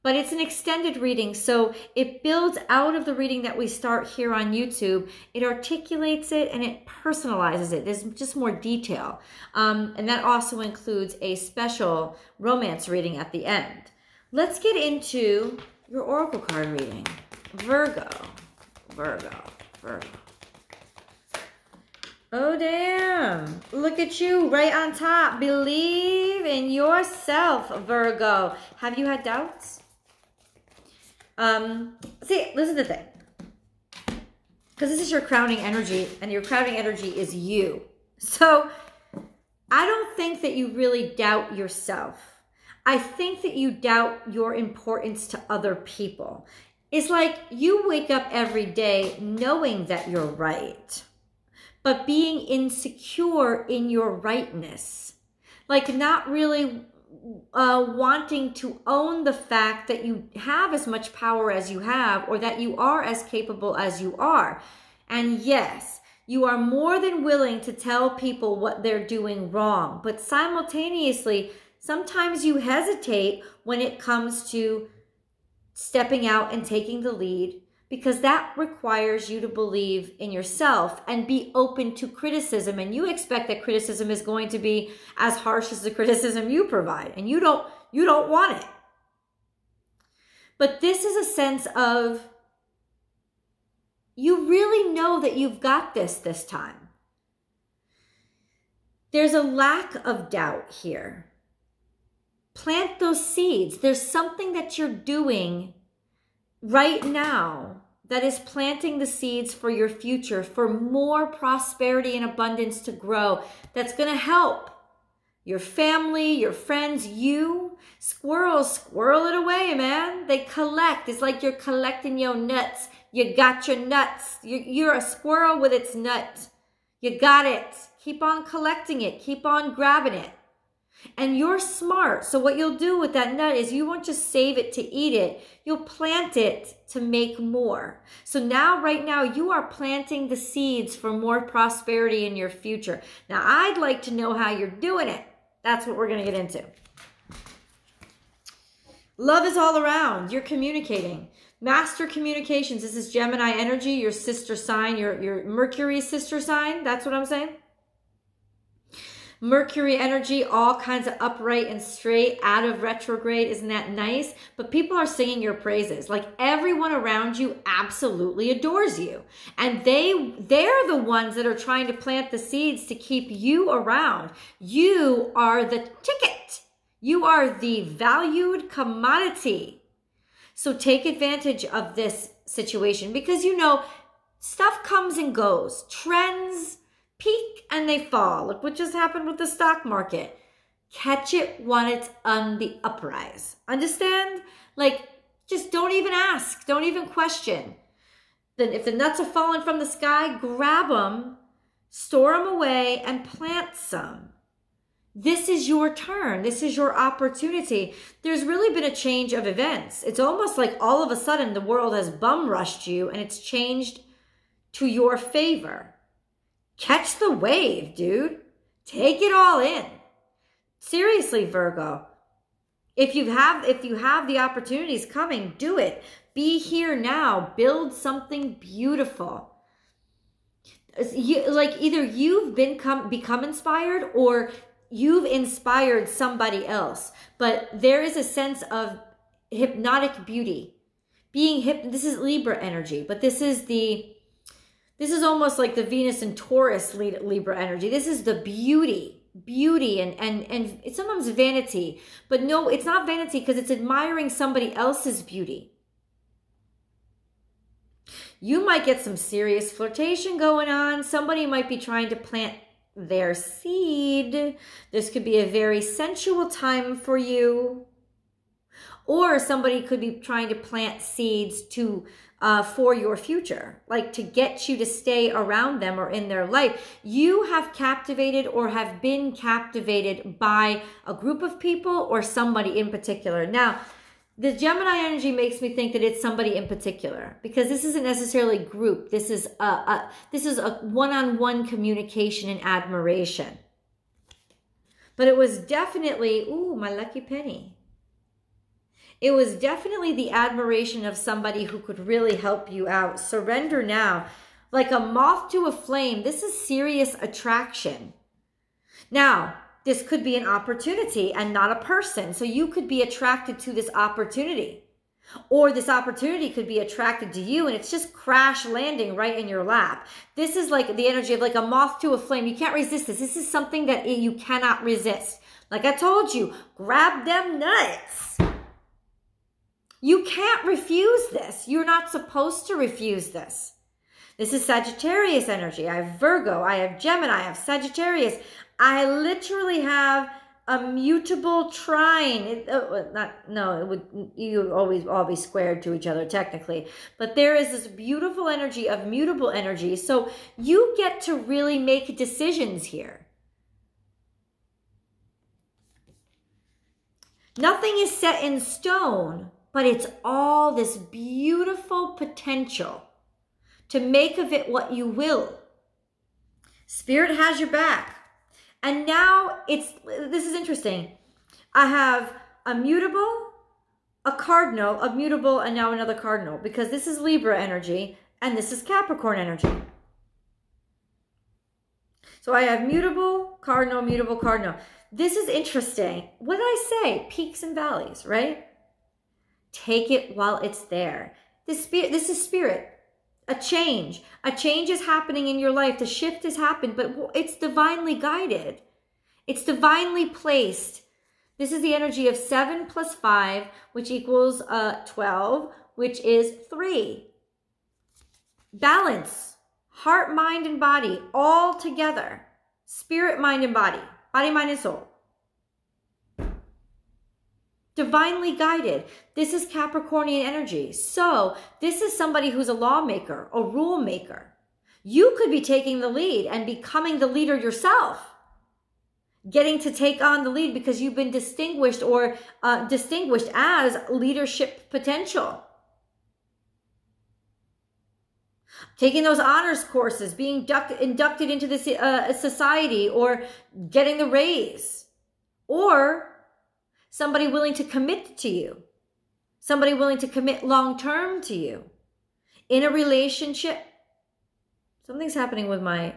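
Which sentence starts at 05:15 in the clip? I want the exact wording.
Or this opportunity could be attracted to you and it's just crash landing right in your lap.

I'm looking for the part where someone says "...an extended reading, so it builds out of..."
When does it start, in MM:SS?
00:00.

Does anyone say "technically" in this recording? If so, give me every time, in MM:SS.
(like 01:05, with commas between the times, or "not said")
05:46.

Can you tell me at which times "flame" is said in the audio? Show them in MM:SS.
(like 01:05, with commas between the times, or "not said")
05:05, 05:22.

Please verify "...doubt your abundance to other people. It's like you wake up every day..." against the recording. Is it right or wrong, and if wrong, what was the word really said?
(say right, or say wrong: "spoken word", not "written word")
wrong: "importance", not "abundance".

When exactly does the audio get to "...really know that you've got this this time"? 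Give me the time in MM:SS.
01:34.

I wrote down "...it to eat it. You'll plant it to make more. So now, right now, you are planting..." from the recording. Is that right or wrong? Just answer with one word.
right.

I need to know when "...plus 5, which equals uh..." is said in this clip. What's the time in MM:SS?
06:42.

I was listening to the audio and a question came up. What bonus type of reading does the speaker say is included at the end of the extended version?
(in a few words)
romance reading.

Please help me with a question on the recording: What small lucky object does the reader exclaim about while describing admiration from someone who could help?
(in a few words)
lucky penny.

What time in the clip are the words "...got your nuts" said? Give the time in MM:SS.
02:03.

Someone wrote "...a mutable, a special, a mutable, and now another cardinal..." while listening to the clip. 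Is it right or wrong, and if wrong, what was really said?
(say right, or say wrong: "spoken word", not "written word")
wrong: "cardinal", not "special".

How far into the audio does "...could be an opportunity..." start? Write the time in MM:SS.
05:10.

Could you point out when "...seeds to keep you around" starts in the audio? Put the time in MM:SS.
02:52.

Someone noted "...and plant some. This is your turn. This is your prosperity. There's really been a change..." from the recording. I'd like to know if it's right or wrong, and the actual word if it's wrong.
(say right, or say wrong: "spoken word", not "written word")
wrong: "opportunity", not "prosperity".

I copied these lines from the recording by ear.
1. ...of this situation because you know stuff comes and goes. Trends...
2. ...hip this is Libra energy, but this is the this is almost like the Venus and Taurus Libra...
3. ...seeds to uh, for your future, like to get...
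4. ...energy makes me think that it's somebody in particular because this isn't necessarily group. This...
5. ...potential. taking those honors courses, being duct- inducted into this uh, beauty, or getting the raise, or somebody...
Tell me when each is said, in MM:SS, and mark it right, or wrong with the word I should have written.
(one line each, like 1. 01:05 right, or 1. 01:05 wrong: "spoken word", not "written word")
1. 03:01 right
2. 04:01 right
3. 04:31 right
4. 04:44 right
5. 07:14 wrong: "society", not "beauty".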